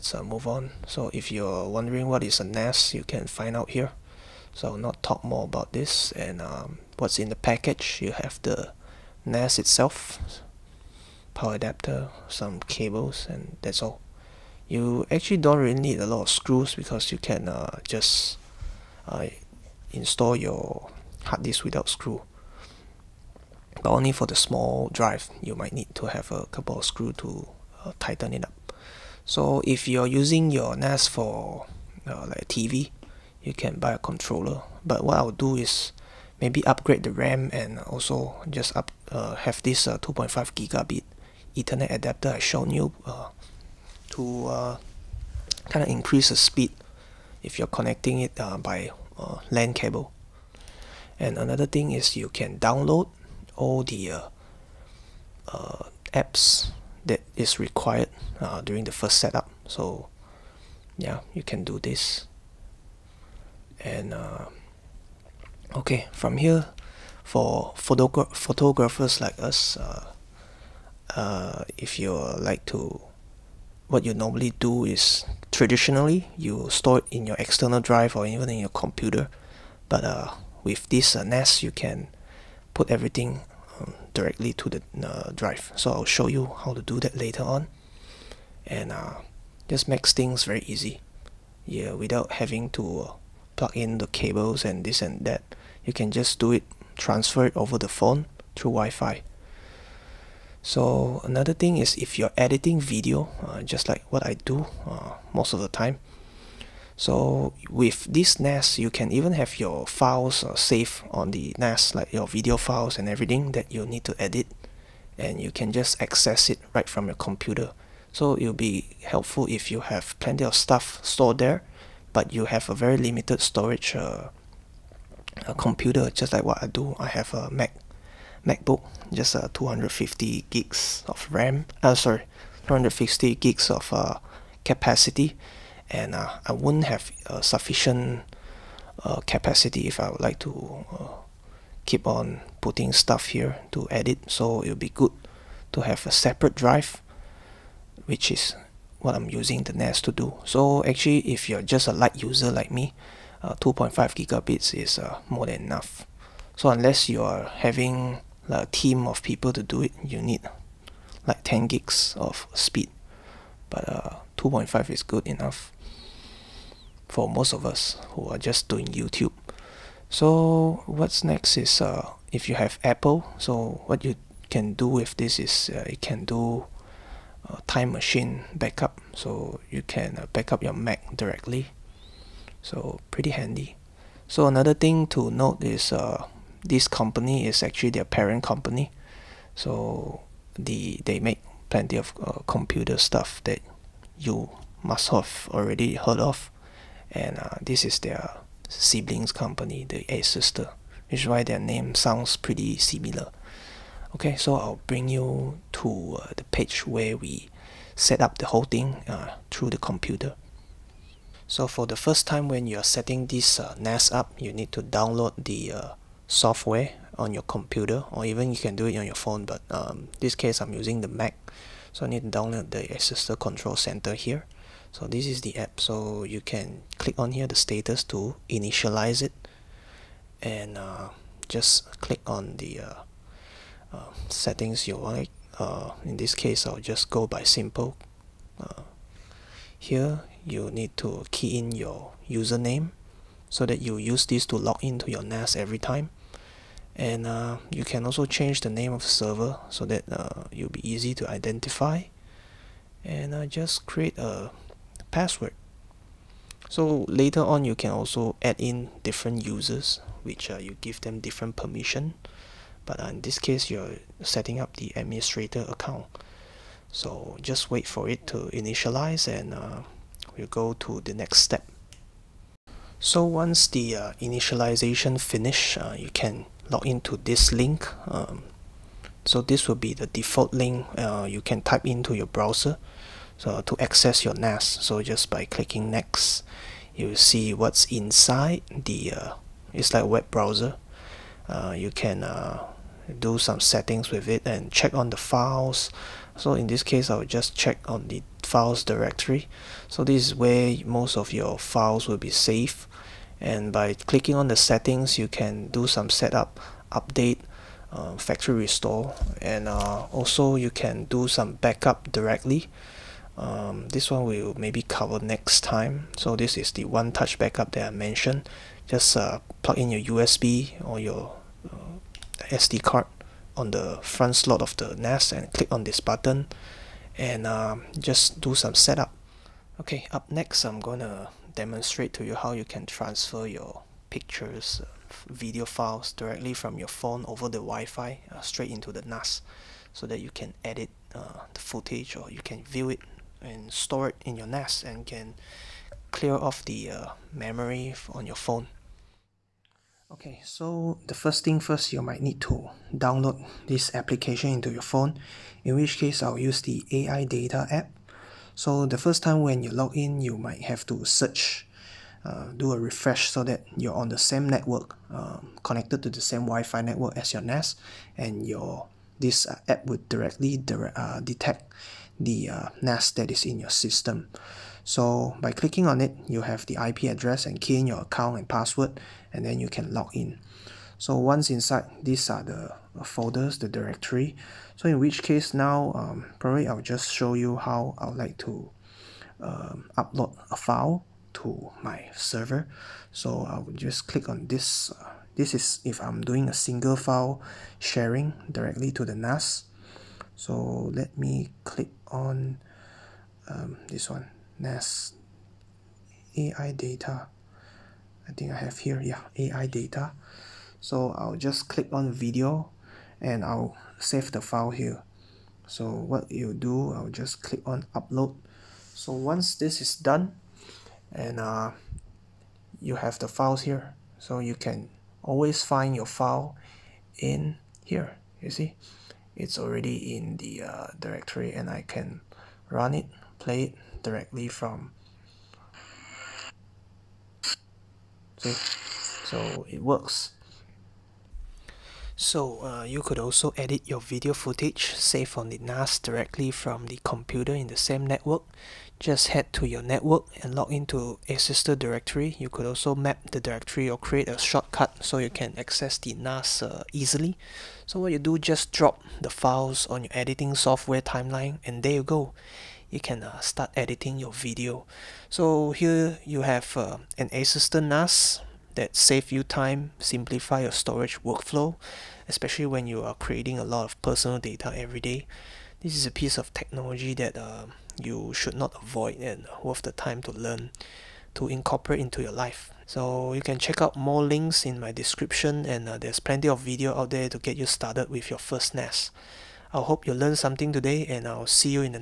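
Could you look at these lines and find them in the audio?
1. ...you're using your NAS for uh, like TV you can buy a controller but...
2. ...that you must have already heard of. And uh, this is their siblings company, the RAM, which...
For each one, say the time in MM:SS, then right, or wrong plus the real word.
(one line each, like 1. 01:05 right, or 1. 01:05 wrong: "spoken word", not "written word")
1. 00:29 right
2. 03:13 wrong: "Asustor", not "RAM".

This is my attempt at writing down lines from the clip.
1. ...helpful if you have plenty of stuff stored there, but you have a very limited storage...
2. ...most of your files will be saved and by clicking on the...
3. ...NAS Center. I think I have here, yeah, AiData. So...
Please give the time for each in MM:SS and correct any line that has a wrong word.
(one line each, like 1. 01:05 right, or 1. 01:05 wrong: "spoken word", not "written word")
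1. 01:59 right
2. 05:00 right
3. 06:44 wrong: "AiData", not "Center".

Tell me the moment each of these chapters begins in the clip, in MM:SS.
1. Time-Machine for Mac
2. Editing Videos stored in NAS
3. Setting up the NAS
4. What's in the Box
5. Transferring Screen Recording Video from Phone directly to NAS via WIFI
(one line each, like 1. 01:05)
1. 02:51
2. 07:20
3. 03:29
4. 00:06
5. 05:48.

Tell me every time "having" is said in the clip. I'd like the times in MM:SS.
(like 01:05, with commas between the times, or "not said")
01:32, 02:37.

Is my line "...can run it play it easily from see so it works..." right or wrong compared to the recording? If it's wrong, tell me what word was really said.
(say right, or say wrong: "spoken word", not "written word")
wrong: "directly", not "easily".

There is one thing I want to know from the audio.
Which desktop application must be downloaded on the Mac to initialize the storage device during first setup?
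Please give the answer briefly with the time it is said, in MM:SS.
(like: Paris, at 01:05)
Asustor Control Center, at 03:42.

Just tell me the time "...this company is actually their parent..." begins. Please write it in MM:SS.
03:06.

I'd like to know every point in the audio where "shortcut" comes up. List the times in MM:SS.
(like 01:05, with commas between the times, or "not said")
07:34.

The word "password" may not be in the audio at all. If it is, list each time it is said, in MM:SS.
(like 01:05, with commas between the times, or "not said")
04:15, 06:18.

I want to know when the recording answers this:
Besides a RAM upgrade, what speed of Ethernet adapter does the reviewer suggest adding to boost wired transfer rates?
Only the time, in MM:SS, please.
00:39.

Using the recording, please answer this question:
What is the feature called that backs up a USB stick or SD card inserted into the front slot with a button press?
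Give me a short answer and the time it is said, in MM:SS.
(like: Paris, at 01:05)
One Touch Backup, at 05:16.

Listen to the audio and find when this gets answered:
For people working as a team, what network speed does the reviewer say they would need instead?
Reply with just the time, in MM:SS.
02:41.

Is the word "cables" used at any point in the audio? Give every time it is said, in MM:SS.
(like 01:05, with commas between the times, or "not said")
00:12, 00:49, 01:34.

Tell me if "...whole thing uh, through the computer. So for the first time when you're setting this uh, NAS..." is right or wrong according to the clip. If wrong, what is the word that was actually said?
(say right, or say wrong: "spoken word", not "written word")
right.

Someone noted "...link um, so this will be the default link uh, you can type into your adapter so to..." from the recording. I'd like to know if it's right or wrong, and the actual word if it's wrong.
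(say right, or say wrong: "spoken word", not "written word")
wrong: "browser", not "adapter".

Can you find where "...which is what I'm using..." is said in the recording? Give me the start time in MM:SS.
02:28.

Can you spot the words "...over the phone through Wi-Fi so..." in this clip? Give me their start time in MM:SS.
01:37.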